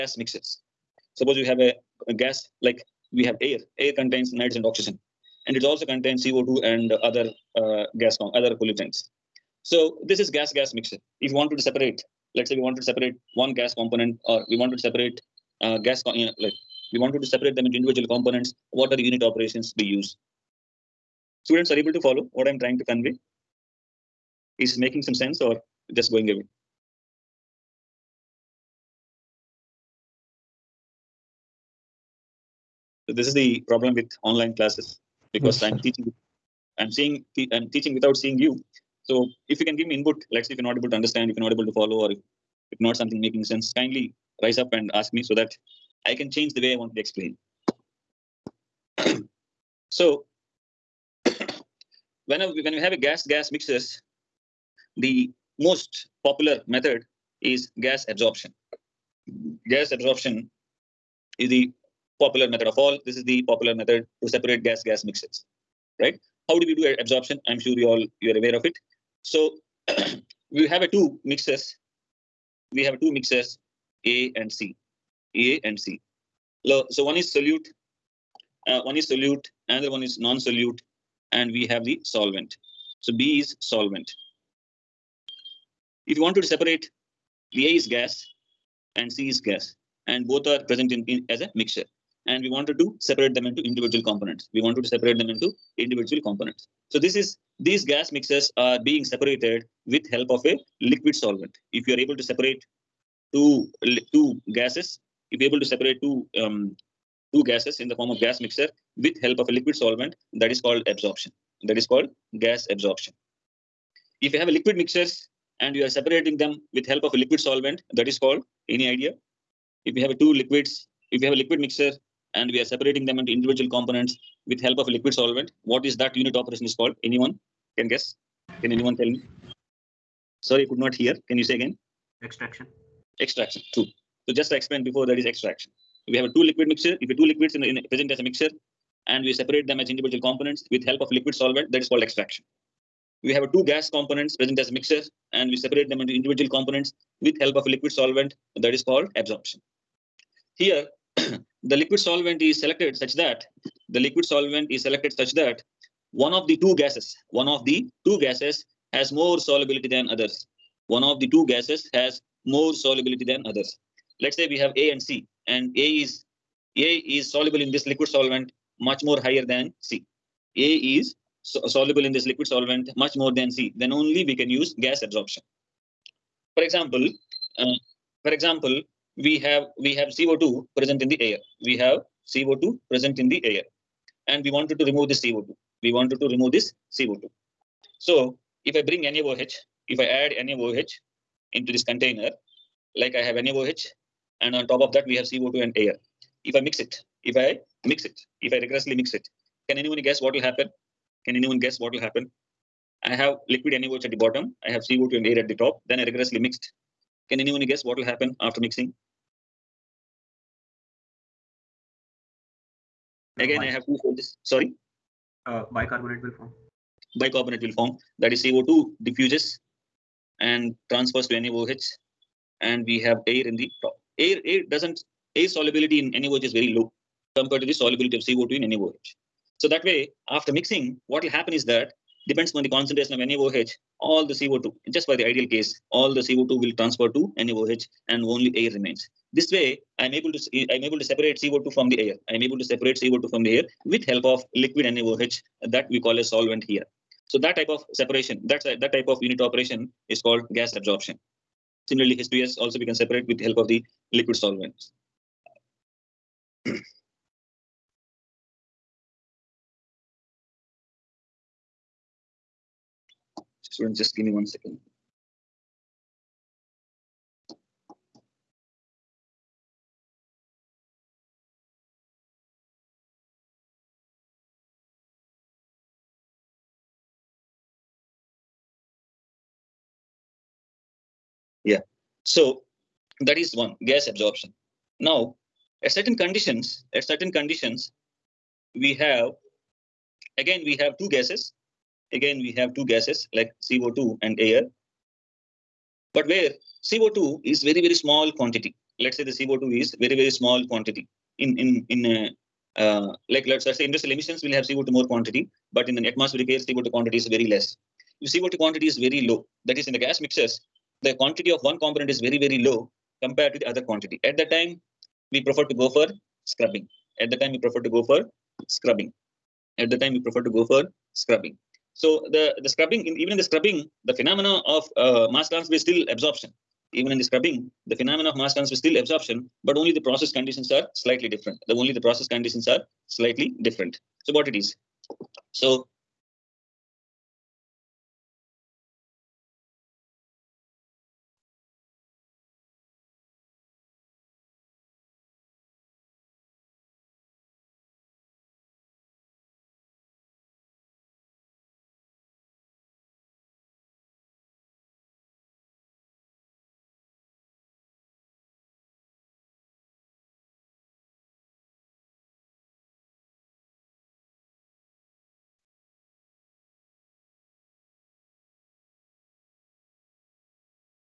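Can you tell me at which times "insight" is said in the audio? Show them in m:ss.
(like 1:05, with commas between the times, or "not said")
not said.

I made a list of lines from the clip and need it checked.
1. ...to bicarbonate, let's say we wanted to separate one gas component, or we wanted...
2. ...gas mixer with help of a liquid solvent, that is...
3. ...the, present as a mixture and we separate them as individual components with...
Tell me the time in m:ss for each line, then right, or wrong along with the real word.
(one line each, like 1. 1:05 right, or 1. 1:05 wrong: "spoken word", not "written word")
1. 0:11 wrong: "separate", not "bicarbonate"
2. 1:48 right
3. 2:17 right.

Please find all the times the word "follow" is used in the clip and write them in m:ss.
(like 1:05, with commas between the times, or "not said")
0:21, 0:41.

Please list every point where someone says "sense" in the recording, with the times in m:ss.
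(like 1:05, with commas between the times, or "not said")
0:25, 0:43.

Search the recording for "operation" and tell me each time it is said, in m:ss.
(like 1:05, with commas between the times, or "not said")
0:19, 2:06, 4:09.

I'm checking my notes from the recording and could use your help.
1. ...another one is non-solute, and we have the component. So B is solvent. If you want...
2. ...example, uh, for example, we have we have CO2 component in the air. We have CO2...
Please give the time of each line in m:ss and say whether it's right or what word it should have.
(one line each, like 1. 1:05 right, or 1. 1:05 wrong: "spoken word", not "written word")
1. 1:19 wrong: "solvent", not "component"
2. 2:56 wrong: "present", not "component".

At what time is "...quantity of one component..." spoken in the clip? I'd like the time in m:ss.
5:11.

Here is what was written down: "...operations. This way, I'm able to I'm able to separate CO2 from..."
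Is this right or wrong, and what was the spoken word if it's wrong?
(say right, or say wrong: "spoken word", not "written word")
wrong: "remains", not "operations".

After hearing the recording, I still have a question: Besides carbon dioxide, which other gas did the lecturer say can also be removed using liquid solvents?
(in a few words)
H2S.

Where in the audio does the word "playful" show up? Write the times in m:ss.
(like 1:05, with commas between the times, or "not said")
not said.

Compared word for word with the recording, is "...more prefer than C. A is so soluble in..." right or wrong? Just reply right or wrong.
wrong.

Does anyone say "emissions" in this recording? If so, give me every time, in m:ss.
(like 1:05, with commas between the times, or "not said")
5:04.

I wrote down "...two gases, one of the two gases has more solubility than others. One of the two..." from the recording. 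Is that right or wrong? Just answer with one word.
right.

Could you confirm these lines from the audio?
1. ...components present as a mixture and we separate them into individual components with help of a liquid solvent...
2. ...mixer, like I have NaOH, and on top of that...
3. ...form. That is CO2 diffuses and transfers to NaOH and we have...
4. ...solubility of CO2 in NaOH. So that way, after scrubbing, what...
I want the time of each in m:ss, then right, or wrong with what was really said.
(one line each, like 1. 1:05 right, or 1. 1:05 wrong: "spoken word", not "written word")
1. 2:23 right
2. 3:11 wrong: "container", not "mixer"
3. 3:37 right
4. 3:47 wrong: "mixing", not "scrubbing".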